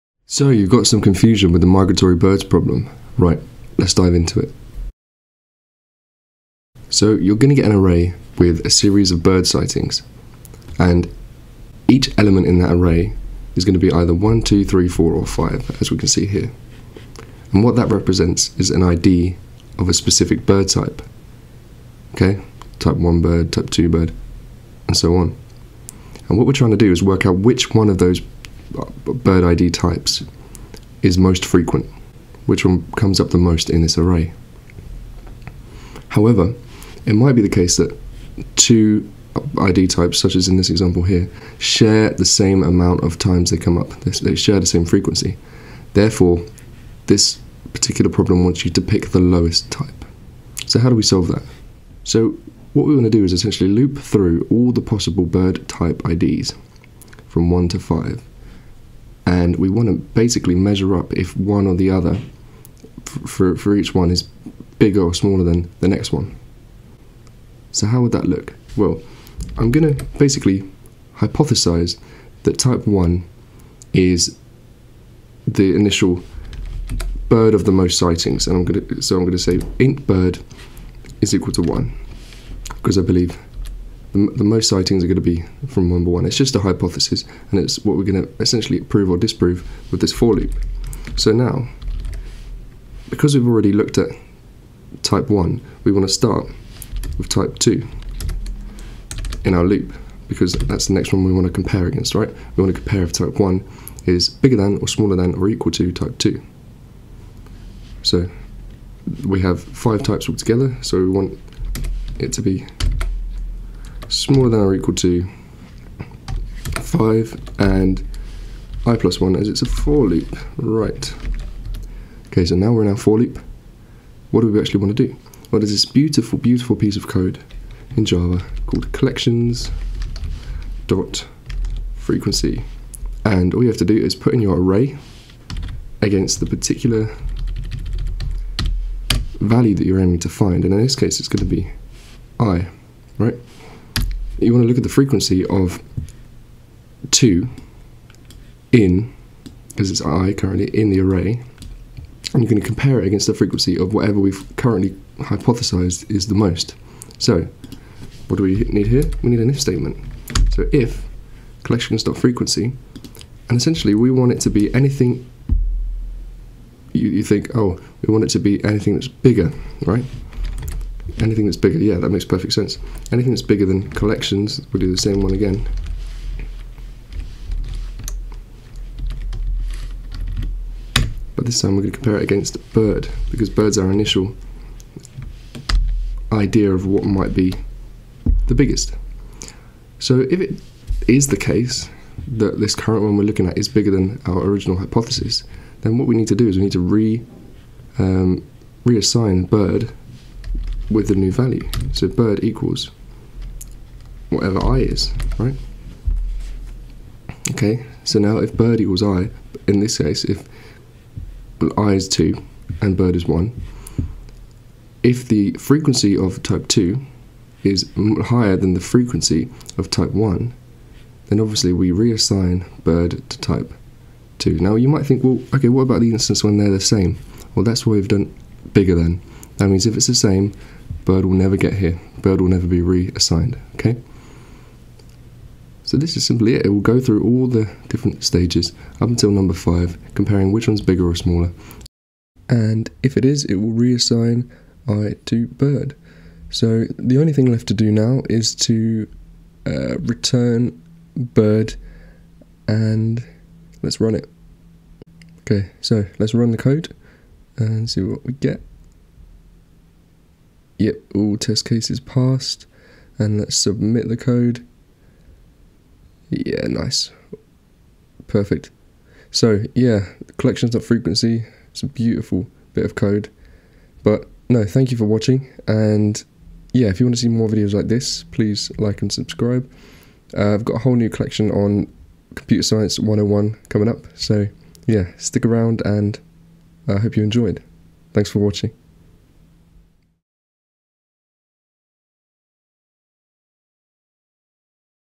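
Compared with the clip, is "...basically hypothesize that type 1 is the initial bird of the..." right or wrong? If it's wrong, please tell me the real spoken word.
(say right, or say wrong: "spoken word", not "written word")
right.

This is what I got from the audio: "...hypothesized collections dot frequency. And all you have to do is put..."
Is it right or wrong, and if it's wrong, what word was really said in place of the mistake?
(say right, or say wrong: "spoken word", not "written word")
wrong: "called", not "hypothesized".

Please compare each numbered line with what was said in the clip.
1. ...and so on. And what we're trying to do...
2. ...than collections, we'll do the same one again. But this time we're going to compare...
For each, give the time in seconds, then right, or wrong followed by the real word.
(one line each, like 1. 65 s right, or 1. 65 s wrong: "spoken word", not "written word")
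1. 24 s right
2. 173 s right.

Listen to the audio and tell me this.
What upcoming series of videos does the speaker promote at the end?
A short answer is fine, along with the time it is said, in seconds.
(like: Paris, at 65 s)
Computer Science 101, at 282 s.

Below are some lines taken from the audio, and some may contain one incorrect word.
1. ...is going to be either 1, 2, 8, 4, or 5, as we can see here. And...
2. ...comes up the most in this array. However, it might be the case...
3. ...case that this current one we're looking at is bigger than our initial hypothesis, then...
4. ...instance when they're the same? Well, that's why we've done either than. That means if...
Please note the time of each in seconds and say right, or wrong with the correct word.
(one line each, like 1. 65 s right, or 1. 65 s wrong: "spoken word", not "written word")
1. 13 s wrong: "3", not "8"
2. 32 s right
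3. 191 s wrong: "original", not "initial"
4. 226 s wrong: "bigger", not "either".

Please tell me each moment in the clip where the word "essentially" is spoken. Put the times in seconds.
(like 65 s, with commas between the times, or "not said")
53 s, 88 s, 163 s.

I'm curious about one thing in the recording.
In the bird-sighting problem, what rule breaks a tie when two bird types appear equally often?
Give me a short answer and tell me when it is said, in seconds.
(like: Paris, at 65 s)
pick the lowest type, at 48 s.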